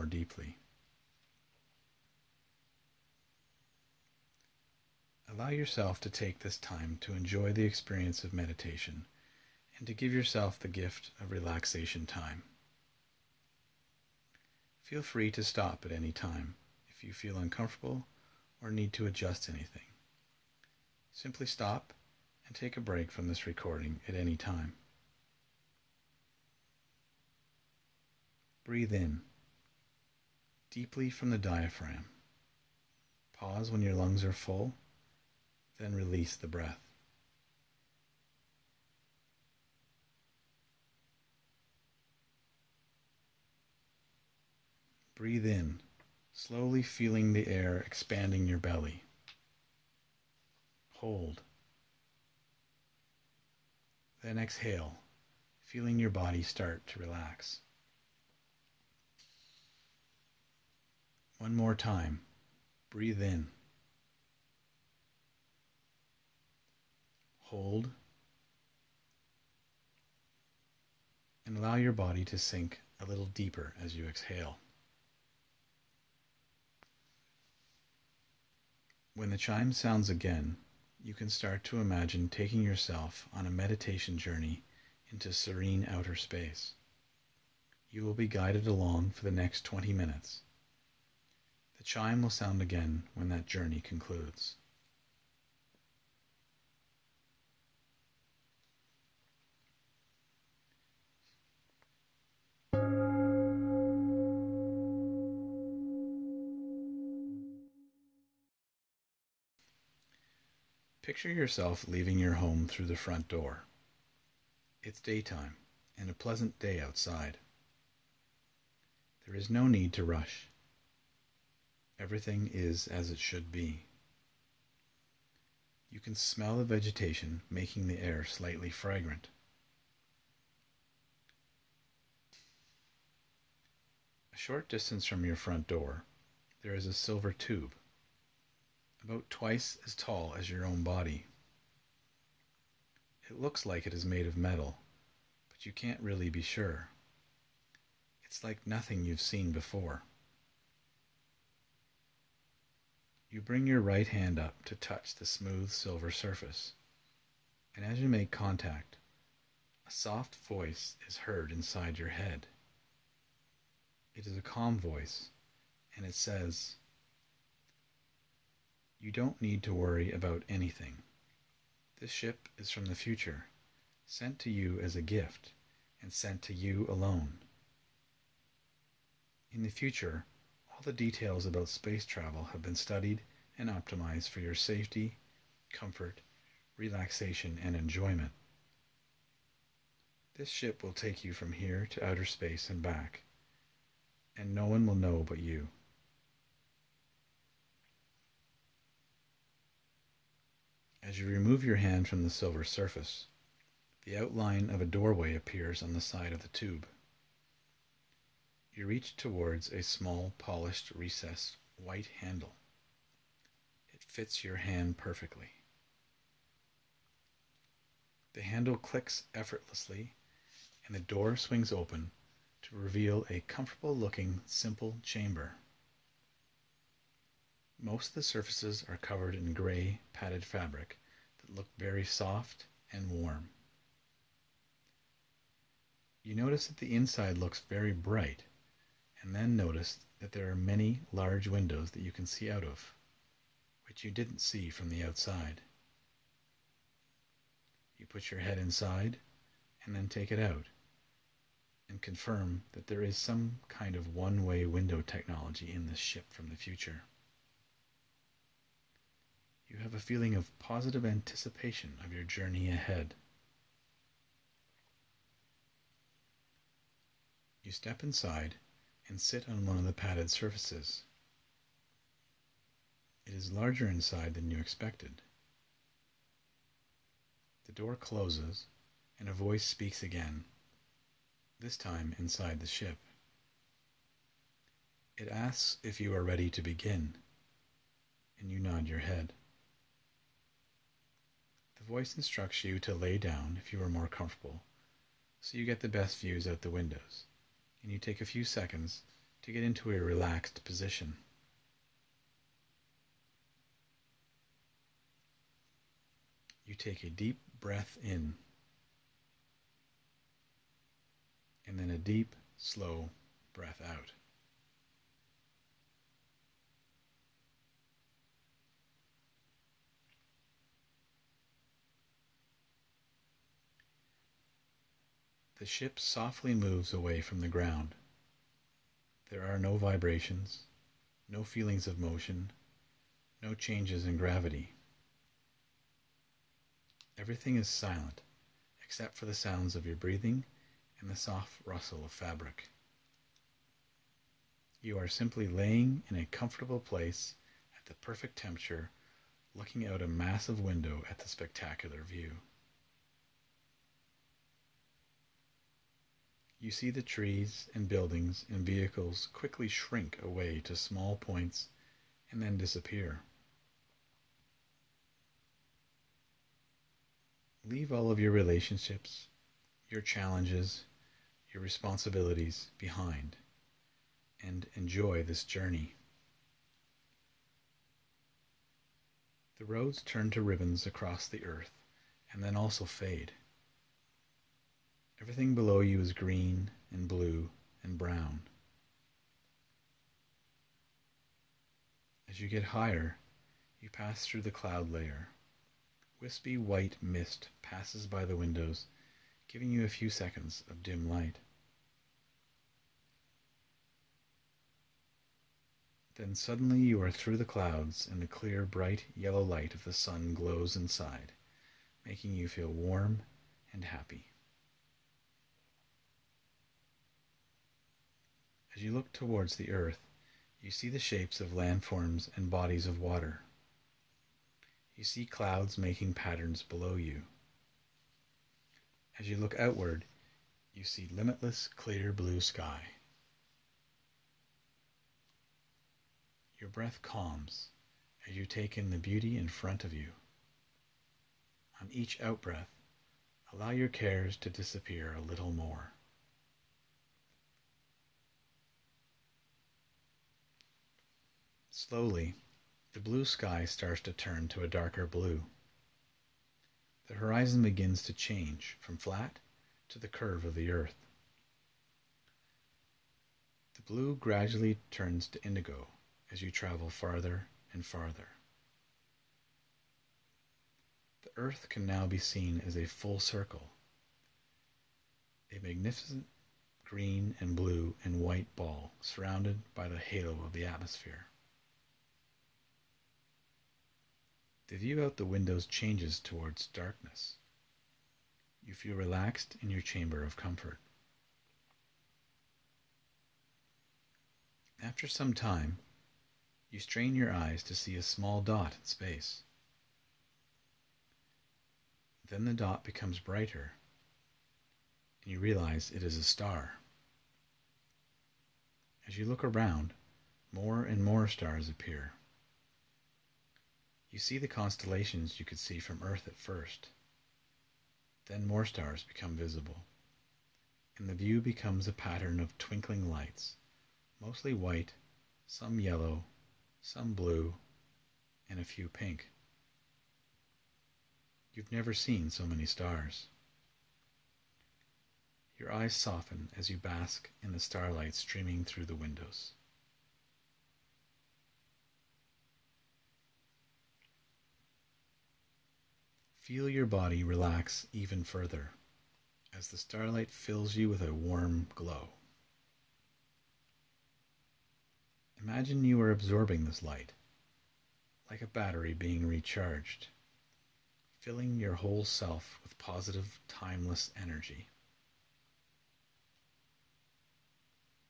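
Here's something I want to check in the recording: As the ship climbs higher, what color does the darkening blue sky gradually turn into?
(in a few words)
Indigo.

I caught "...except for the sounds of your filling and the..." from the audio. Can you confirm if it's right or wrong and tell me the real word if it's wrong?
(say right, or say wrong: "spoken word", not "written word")
wrong: "breathing", not "filling".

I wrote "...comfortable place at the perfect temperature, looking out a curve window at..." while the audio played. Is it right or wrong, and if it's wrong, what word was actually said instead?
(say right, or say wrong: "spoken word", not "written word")
wrong: "massive", not "curve".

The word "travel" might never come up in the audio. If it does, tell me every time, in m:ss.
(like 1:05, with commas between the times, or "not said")
3:02, 7:46.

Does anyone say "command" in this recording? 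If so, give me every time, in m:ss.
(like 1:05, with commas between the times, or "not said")
not said.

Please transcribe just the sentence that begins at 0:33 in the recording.
Pause when your lungs are full, then release the breath.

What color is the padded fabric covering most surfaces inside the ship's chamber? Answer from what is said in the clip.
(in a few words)
Gray.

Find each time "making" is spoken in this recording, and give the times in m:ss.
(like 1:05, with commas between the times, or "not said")
2:07, 6:52, 7:05.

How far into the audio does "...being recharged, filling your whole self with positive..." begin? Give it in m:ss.
9:18.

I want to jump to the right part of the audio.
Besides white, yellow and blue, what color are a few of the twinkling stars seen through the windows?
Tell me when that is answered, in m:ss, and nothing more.
8:48.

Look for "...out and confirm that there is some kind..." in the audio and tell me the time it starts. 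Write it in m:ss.
4:10.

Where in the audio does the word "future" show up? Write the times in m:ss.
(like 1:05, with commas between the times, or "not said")
2:52, 2:59, 4:16.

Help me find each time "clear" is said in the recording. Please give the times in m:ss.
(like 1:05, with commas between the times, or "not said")
6:48, 7:11.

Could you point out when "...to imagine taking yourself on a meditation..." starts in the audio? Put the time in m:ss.
1:21.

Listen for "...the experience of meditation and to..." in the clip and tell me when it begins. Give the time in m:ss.
0:07.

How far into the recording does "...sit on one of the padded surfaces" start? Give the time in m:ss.
4:29.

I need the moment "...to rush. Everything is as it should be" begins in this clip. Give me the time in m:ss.
1:59.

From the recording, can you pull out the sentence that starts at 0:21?
Simply stop and take a break from this recording at any time.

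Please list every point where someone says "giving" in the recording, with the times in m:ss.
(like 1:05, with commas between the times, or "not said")
6:39.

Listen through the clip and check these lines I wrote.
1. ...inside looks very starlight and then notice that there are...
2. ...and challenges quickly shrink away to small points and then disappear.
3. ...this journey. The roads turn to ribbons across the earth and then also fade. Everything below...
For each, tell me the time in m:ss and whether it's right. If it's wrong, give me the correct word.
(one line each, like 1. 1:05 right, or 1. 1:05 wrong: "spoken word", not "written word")
1. 3:56 wrong: "bright", not "starlight"
2. 5:58 wrong: "vehicles", not "challenges"
3. 6:15 right.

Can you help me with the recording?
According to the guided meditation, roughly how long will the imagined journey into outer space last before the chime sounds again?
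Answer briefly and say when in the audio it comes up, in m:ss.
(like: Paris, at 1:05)
20 minutes, at 1:29.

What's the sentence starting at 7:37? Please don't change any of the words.
The horizon begins to change from flat to the curve of the earth.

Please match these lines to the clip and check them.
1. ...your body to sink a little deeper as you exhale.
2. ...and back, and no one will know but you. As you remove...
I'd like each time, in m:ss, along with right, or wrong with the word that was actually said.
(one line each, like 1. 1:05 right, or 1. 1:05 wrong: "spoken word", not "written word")
1. 1:11 right
2. 3:12 right.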